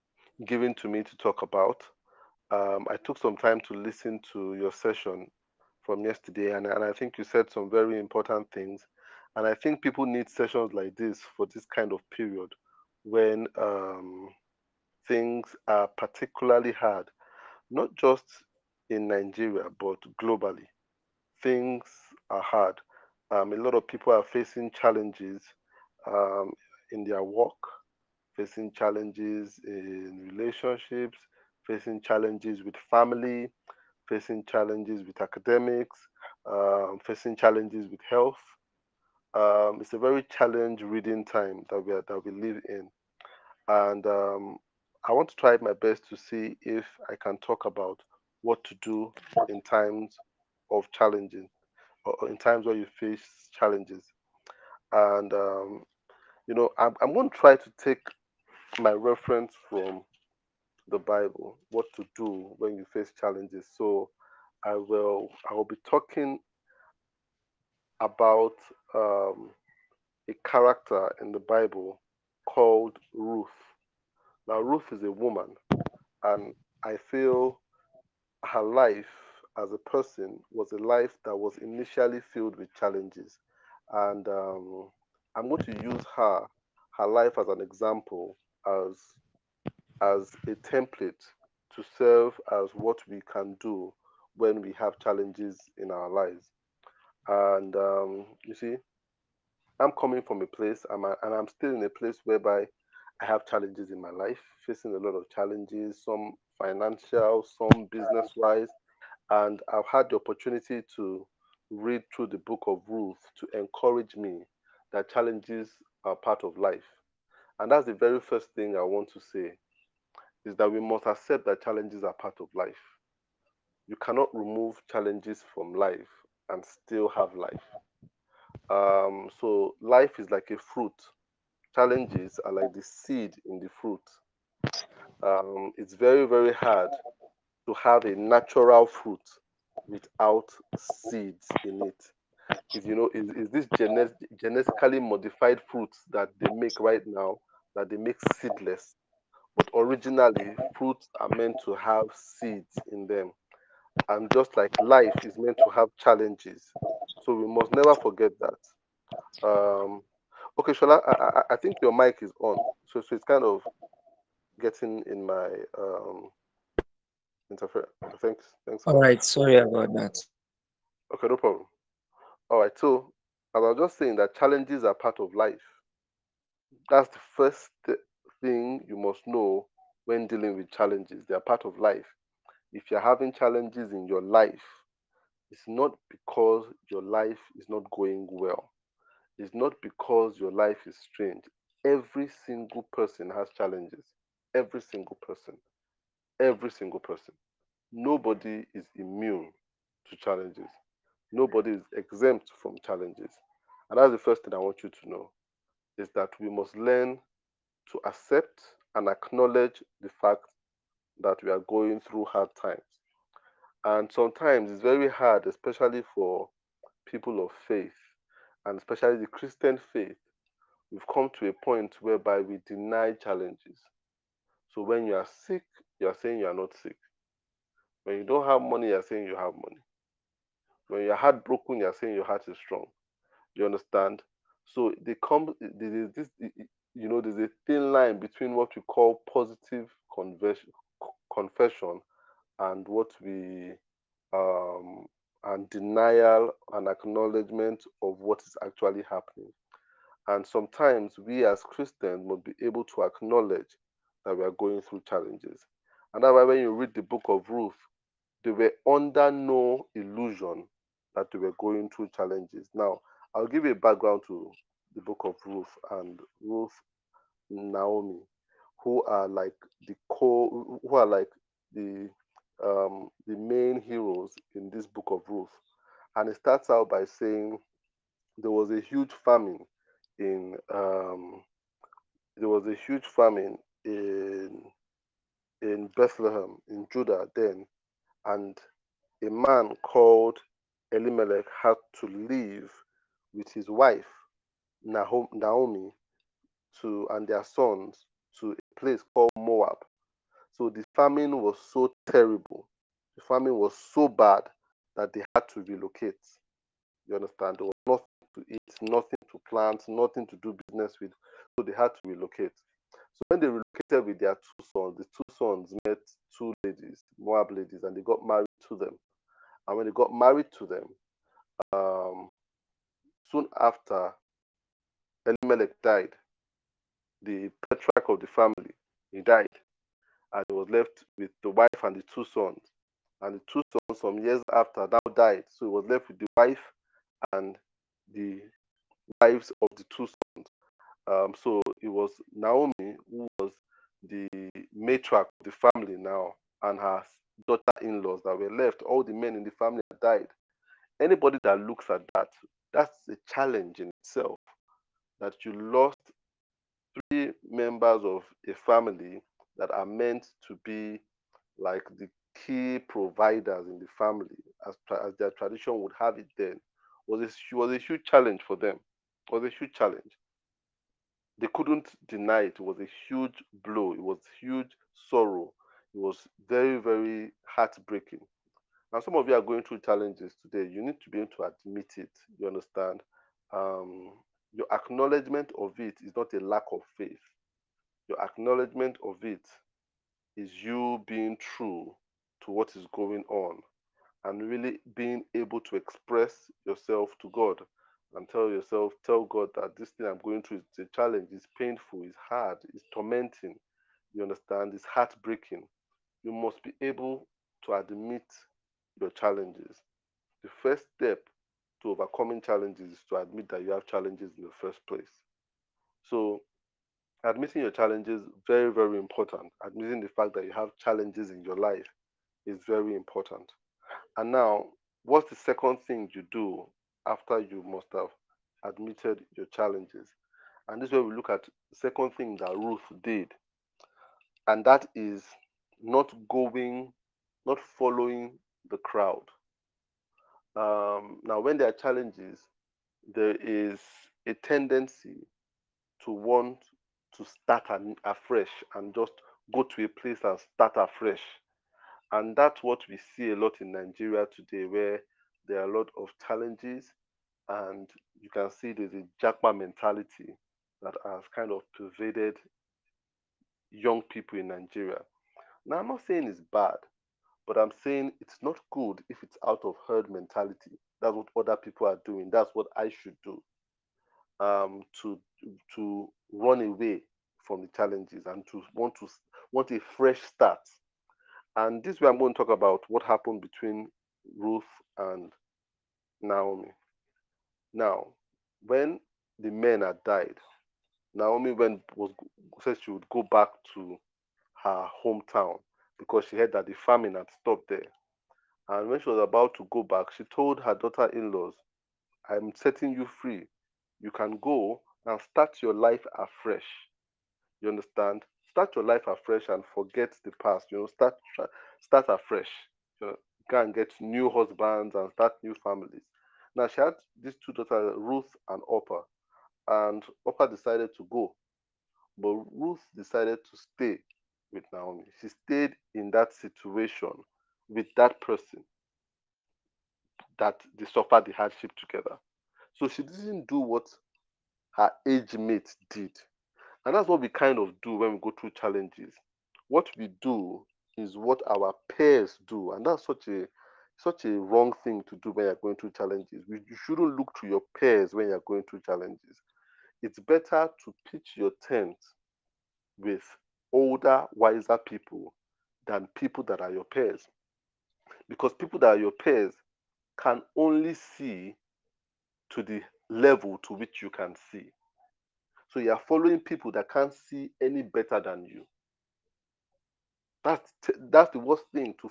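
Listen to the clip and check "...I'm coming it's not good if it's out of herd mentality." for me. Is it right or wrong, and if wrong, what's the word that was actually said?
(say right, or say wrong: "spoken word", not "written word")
wrong: "saying", not "coming".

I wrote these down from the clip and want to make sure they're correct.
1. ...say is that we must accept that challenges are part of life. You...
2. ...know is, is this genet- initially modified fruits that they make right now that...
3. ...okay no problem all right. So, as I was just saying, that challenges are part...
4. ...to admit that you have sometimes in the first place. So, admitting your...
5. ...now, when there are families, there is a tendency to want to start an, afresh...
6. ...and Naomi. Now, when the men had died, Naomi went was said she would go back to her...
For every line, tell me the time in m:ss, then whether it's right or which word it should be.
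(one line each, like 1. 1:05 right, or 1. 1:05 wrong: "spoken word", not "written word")
1. 1:59 right
2. 2:22 wrong: "genetically", not "initially"
3. 2:51 right
4. 6:53 wrong: "challenges", not "sometimes"
5. 7:21 wrong: "challenges", not "families"
6. 8:04 right.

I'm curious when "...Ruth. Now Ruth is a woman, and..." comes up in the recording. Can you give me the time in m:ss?
1:13.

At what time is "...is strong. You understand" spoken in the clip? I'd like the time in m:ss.
3:52.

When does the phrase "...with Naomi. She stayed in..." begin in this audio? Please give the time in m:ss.
8:44.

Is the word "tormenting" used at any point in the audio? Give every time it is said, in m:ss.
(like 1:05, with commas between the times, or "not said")
6:42.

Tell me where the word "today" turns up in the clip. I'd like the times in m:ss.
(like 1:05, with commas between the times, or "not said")
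6:20, 7:34.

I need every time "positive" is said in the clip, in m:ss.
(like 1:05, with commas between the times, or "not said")
3:59.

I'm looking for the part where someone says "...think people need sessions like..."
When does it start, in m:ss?
0:09.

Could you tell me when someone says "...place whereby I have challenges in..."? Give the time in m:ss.
1:41.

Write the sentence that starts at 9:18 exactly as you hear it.
Because people that are your peers can only see to the level to which you can see.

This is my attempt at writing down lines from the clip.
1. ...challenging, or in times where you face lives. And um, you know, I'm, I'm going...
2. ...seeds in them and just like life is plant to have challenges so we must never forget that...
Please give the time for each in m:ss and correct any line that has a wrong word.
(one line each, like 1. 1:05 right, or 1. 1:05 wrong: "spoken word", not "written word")
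1. 0:50 wrong: "challenges", not "lives"
2. 2:32 wrong: "meant", not "plant".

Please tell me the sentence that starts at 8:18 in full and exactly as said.
And when she was about to go back, she told her daughter in laws, I'm setting you free.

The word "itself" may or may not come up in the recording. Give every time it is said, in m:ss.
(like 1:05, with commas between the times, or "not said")
5:53.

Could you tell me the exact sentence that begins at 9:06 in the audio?
You shouldn't look to your peers when you're going through challenges.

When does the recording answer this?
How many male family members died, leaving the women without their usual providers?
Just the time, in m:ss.
5:56.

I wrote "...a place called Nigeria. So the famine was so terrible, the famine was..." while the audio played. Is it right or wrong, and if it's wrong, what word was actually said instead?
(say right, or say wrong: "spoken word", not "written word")
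wrong: "Moab", not "Nigeria".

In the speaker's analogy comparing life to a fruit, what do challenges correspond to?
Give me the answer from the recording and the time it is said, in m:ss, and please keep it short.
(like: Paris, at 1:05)
The seed, at 2:11.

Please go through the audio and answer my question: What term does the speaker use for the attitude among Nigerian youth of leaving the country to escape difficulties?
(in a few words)
Jackman mentality.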